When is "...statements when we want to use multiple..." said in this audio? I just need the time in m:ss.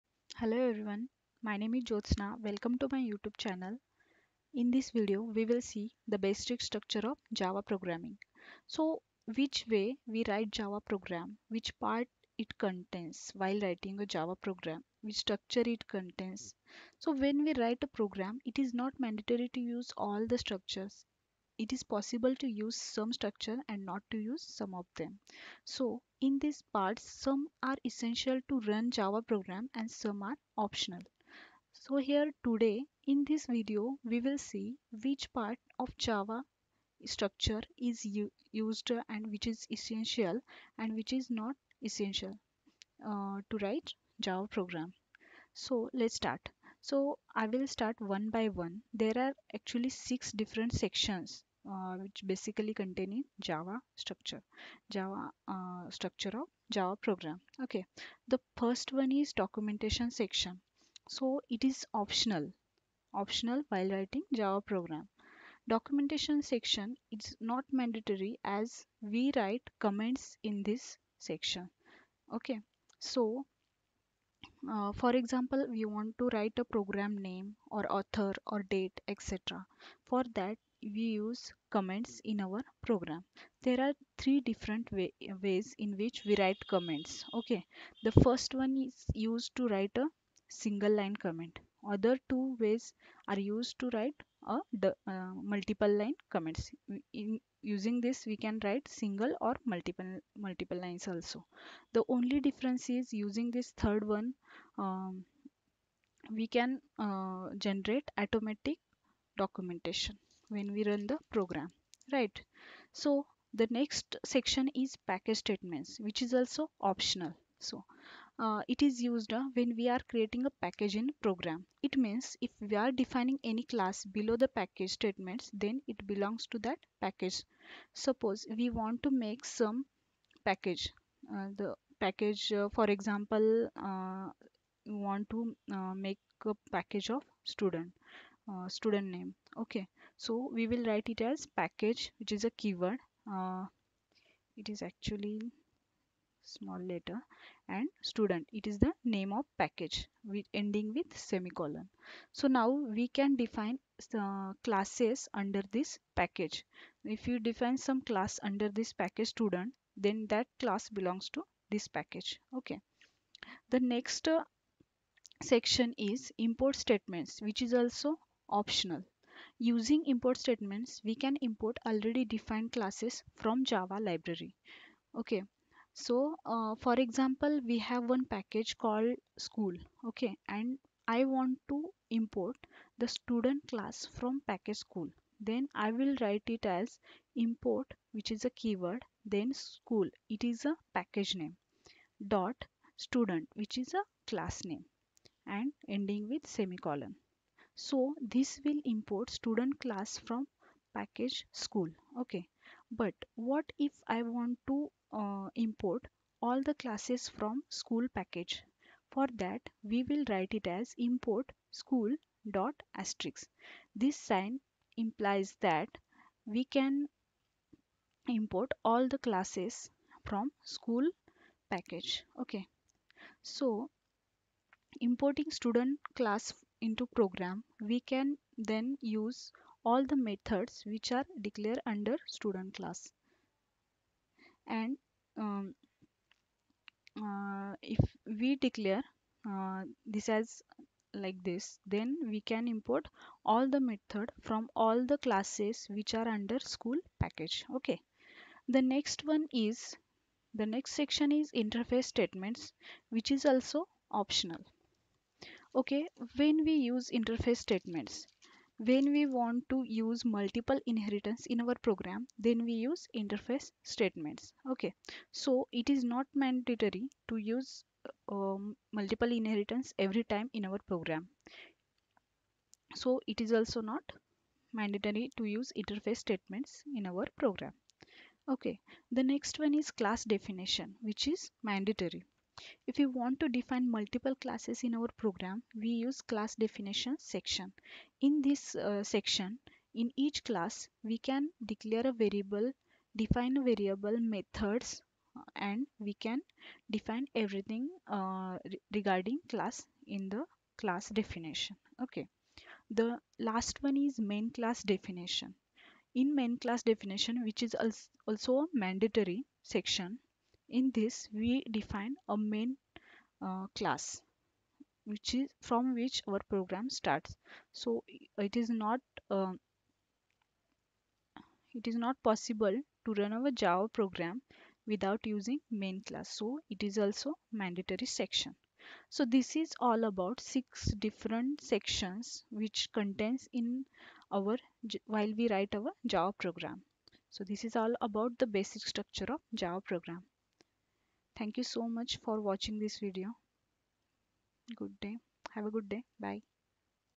4:17.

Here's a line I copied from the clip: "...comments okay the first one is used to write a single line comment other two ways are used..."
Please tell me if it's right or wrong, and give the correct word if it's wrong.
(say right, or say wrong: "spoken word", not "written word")
right.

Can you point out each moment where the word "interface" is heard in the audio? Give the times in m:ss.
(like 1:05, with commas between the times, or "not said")
4:11, 4:17, 4:23, 4:35.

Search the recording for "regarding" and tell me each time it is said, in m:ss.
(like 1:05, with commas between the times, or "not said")
4:58.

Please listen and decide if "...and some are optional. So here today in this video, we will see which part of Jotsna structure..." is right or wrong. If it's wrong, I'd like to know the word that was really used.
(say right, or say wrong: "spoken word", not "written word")
wrong: "Java", not "Jotsna".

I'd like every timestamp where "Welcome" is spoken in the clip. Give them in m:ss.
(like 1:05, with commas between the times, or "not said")
0:02.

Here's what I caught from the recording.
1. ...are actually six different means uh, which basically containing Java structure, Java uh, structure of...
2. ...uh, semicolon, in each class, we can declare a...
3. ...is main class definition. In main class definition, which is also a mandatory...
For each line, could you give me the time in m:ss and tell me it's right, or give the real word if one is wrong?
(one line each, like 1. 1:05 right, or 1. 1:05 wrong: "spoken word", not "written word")
1. 0:49 wrong: "sections", not "means"
2. 4:48 wrong: "section", not "semicolon"
3. 5:03 right.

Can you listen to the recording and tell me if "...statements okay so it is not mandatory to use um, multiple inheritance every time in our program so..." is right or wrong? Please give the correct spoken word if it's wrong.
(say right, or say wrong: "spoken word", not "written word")
right.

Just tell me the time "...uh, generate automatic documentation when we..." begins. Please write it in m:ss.
1:46.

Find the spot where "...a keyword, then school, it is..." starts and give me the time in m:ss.
3:08.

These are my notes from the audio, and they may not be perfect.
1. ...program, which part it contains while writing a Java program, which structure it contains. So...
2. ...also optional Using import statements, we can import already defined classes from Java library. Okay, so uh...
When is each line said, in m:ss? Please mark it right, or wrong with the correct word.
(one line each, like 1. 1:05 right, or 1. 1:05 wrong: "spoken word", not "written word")
1. 0:10 right
2. 2:47 right.